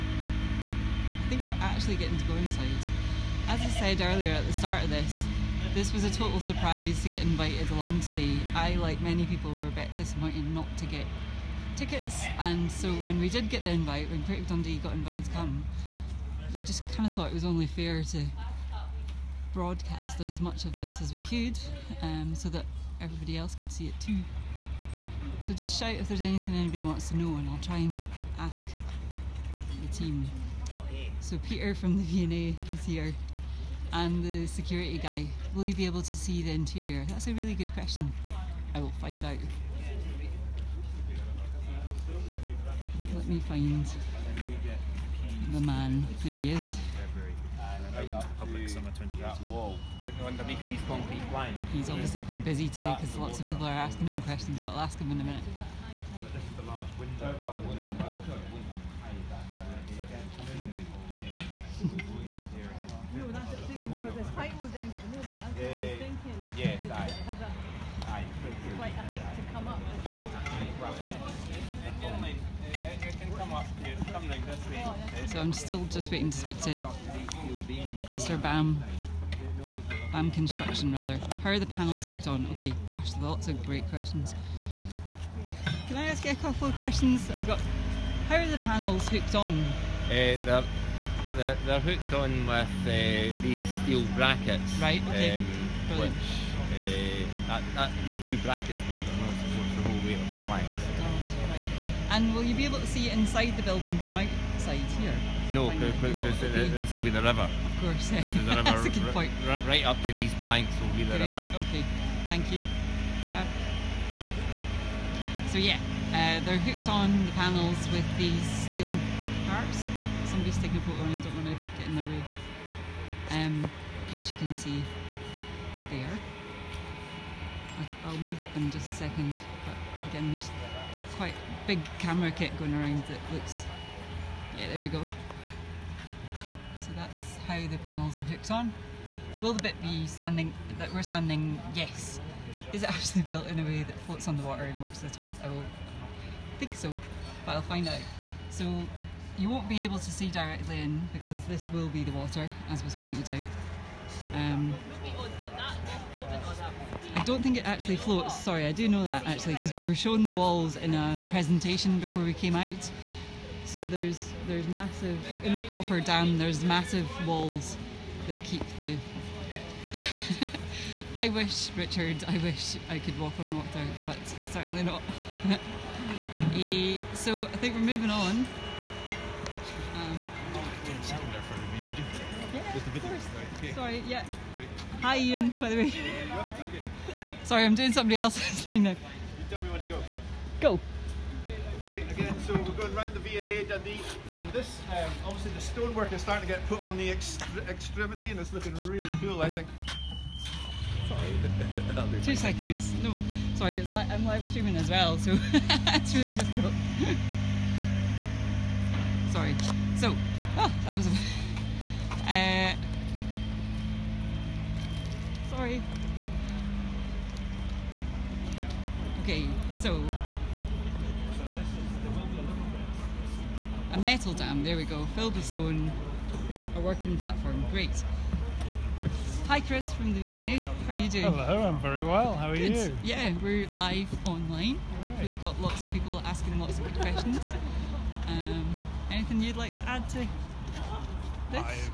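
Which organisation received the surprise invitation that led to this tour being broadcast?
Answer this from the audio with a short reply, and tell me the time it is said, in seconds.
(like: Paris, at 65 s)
Creative Dundee, at 14 s.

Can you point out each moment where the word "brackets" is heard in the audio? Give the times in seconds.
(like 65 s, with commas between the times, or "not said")
94 s, 98 s.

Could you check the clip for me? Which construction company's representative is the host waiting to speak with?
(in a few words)
BAM Construction.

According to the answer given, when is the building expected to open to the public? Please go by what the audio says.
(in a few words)
summer 2018.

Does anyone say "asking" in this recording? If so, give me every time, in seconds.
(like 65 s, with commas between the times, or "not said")
53 s, 236 s.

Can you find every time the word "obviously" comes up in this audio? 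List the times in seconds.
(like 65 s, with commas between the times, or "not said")
51 s, 195 s.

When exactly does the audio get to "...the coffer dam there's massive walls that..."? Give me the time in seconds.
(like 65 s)
165 s.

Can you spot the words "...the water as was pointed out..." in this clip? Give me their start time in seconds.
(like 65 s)
152 s.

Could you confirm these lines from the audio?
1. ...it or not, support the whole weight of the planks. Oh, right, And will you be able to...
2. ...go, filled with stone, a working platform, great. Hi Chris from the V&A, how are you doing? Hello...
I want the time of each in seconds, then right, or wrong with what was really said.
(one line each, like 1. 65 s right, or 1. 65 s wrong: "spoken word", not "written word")
1. 99 s right
2. 224 s right.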